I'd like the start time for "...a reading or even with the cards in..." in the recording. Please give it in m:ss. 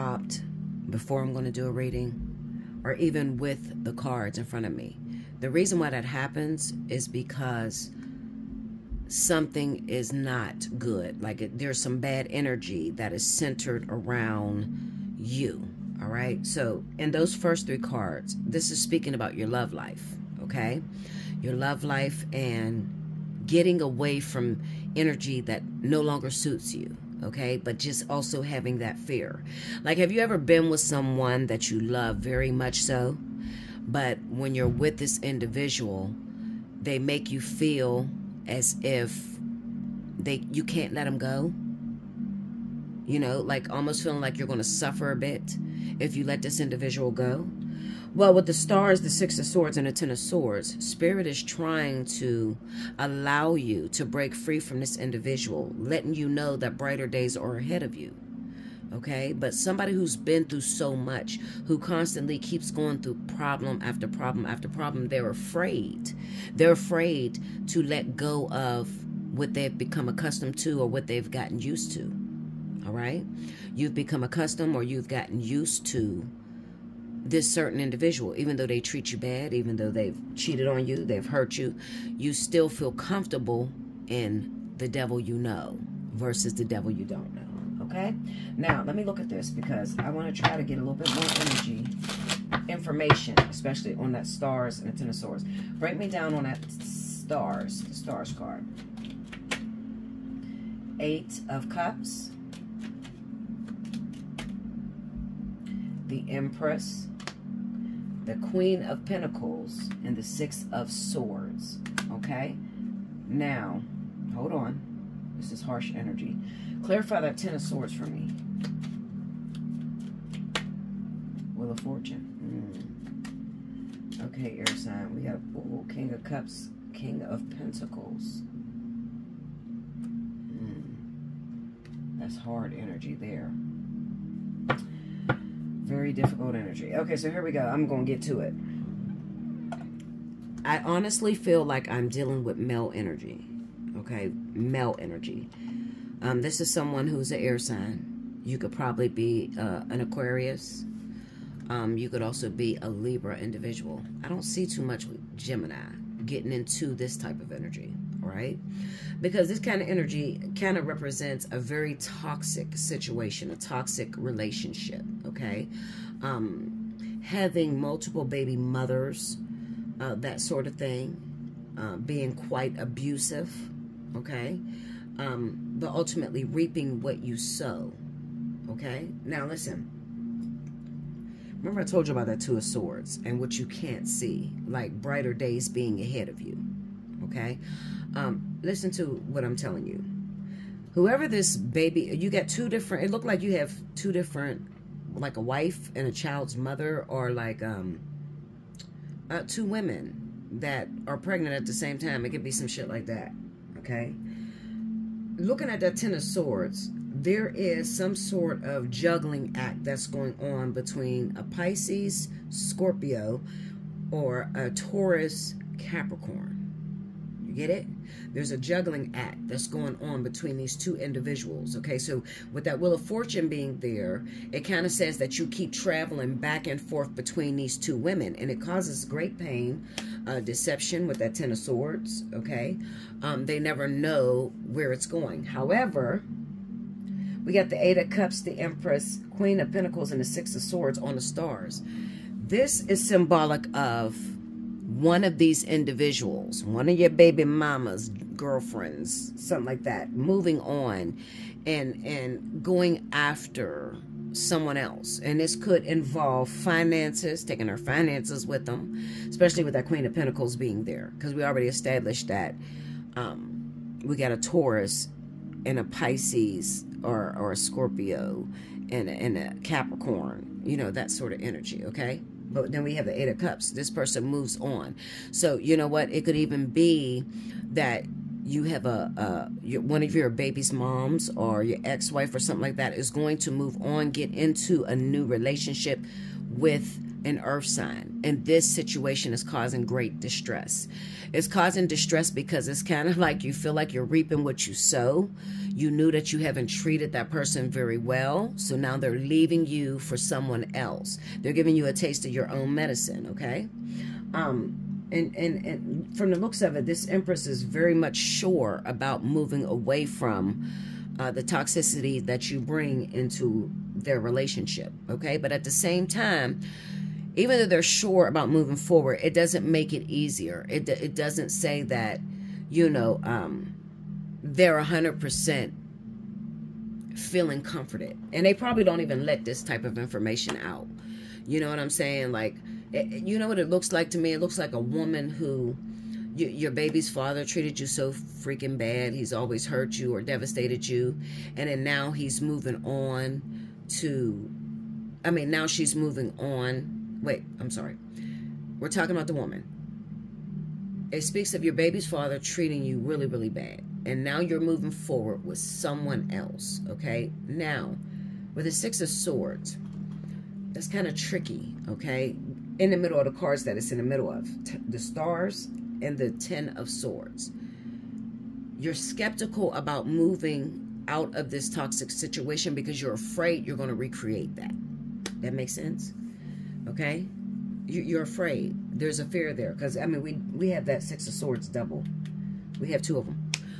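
0:01.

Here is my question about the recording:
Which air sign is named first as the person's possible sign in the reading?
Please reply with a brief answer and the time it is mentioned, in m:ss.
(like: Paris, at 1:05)
Aquarius, at 2:30.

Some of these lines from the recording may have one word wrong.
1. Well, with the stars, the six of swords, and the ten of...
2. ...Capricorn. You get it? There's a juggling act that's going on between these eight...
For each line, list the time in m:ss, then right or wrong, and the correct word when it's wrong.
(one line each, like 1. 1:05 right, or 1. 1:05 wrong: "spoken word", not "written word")
1. 0:48 right
2. 3:35 wrong: "two", not "eight".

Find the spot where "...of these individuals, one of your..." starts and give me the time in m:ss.
4:05.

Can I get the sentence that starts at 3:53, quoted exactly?
Um, they never know where it's going.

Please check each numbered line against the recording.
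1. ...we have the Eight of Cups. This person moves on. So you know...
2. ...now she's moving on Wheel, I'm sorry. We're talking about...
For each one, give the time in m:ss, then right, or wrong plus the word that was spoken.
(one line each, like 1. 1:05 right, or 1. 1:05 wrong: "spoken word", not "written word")
1. 4:32 right
2. 5:45 wrong: "Wait", not "Wheel".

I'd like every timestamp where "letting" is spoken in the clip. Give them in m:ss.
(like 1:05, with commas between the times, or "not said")
0:55.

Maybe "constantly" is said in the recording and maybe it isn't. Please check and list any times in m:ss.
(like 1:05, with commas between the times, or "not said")
1:01.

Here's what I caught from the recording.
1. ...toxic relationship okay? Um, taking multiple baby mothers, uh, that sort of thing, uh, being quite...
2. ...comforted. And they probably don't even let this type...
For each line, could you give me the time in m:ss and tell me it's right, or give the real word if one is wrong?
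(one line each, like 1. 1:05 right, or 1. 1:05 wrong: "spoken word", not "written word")
1. 2:43 wrong: "having", not "taking"
2. 5:27 right.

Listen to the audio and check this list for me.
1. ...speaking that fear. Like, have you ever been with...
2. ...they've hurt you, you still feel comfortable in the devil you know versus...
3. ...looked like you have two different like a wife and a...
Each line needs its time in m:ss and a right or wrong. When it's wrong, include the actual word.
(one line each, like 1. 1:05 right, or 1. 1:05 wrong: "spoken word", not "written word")
1. 0:28 wrong: "having", not "speaking"
2. 1:21 right
3. 3:13 right.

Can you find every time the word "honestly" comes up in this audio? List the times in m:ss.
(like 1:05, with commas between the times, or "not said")
2:20.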